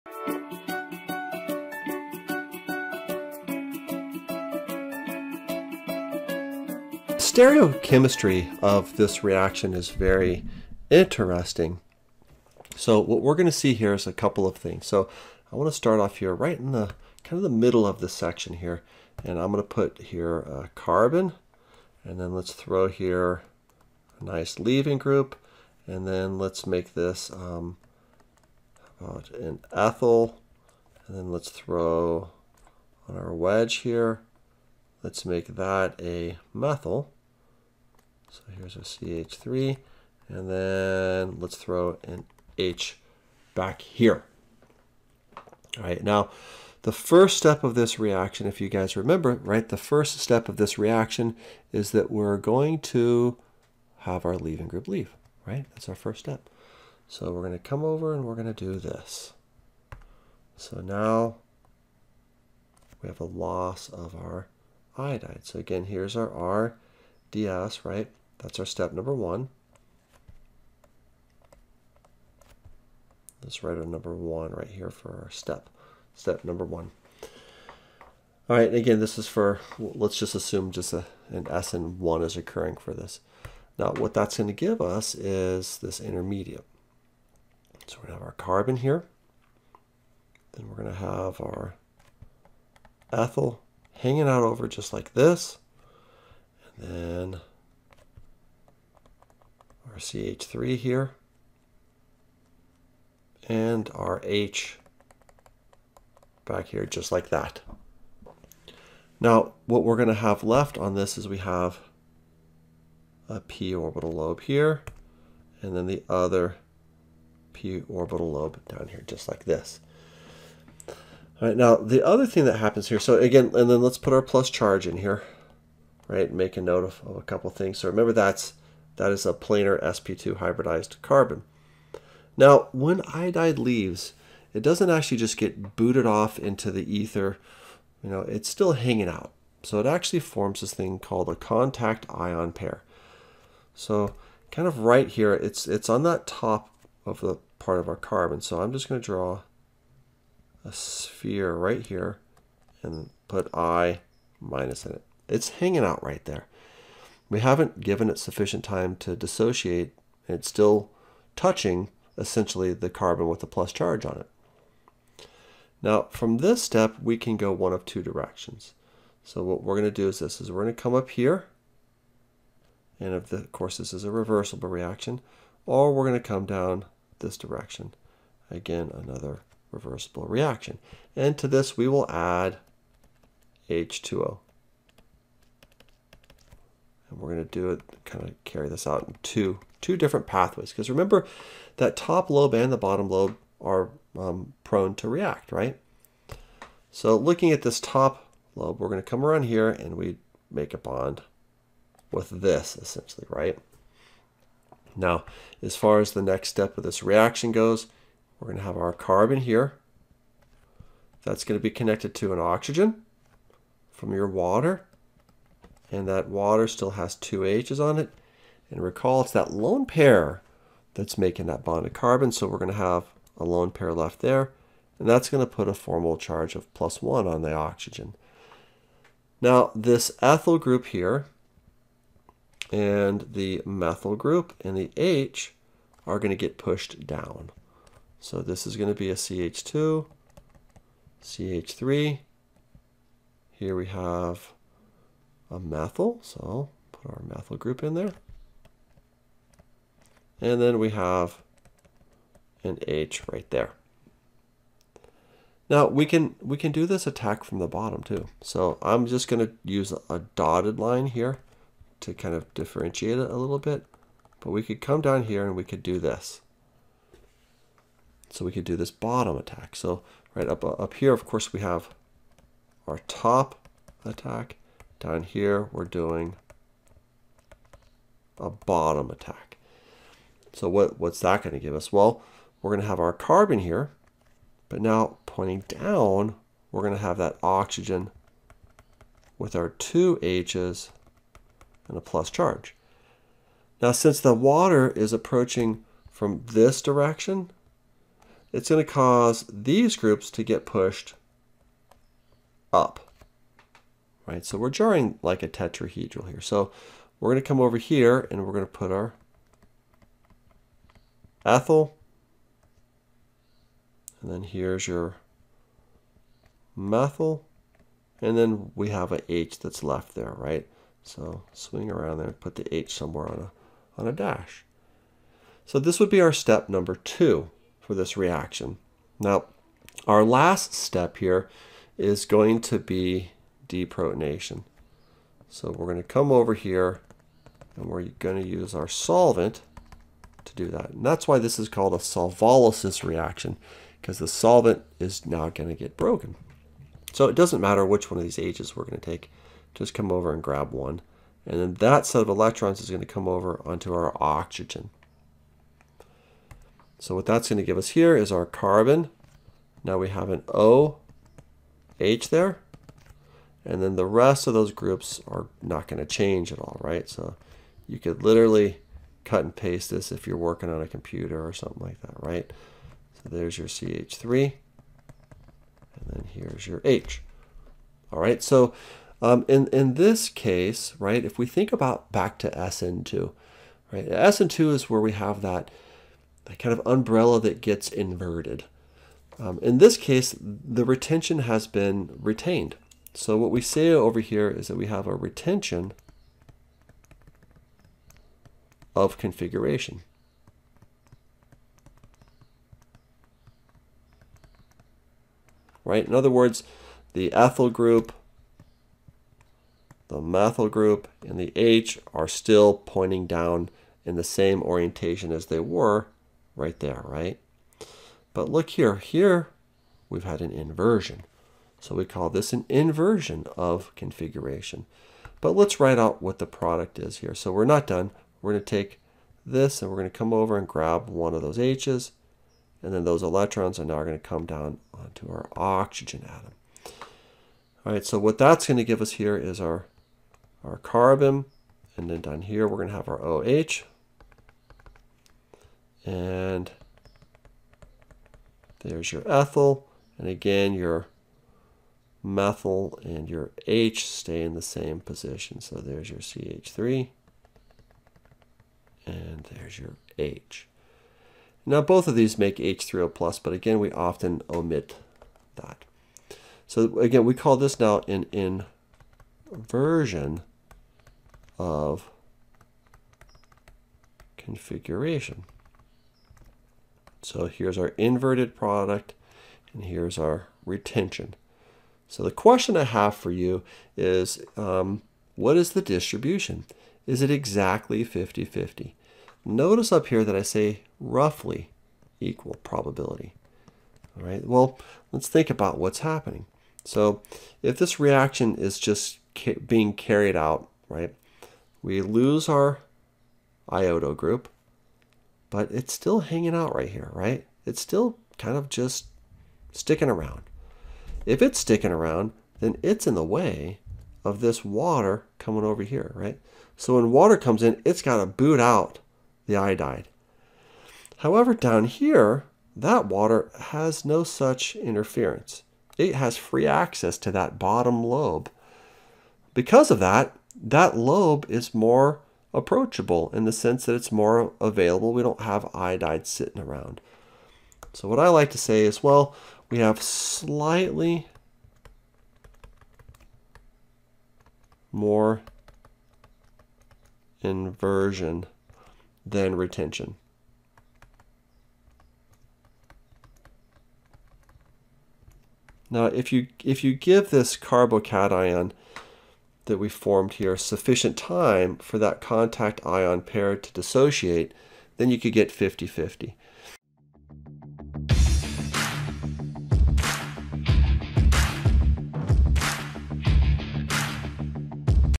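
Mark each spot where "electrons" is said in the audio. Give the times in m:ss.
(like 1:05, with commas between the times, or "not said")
5:52, 7:13.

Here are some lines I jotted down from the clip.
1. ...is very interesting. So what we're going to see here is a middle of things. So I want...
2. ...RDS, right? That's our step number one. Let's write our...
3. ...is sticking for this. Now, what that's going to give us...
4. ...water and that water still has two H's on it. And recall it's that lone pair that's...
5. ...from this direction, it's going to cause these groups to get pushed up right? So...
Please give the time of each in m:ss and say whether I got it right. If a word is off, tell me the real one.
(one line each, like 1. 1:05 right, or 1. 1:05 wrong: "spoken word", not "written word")
1. 0:09 wrong: "couple", not "middle"
2. 1:07 right
3. 1:22 wrong: "occurring", not "sticking"
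4. 3:34 right
5. 4:56 right.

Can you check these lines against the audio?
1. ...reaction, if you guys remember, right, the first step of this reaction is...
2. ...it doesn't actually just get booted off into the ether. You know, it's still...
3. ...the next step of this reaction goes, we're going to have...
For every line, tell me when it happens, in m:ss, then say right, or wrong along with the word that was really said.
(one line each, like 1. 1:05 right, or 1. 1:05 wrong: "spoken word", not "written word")
1. 0:47 right
2. 2:14 right
3. 3:26 right.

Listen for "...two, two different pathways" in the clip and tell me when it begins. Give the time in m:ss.
3:09.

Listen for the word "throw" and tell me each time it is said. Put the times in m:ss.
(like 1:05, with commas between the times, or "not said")
0:22, 0:31, 0:41.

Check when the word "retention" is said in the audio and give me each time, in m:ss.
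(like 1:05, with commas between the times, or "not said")
6:30, 6:35, 8:00, 9:09.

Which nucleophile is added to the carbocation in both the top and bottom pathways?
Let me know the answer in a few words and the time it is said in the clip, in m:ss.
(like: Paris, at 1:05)
H2O, at 3:03.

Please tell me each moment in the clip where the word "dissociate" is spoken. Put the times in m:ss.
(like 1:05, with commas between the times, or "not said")
2:39, 9:23.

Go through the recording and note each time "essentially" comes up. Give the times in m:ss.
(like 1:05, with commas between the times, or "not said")
2:42, 3:22.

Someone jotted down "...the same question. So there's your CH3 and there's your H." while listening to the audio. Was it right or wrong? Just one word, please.
wrong.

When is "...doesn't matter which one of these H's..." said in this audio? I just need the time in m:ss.
5:47.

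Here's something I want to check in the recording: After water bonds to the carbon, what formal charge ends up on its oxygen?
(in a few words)
plus 1.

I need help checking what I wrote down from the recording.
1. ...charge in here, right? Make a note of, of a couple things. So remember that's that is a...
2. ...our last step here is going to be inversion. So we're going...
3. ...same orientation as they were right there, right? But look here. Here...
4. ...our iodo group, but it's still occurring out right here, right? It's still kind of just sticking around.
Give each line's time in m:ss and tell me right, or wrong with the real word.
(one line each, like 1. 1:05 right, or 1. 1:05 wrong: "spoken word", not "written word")
1. 2:04 right
2. 5:30 wrong: "deprotonation", not "inversion"
3. 6:54 right
4. 8:22 wrong: "hanging", not "occurring".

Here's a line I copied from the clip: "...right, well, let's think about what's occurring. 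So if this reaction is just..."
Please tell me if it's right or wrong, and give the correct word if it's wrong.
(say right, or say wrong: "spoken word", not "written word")
wrong: "happening", not "occurring".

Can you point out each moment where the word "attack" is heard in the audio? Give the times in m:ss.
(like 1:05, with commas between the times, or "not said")
4:17, 4:29, 4:34, 4:39.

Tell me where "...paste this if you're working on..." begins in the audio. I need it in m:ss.
6:09.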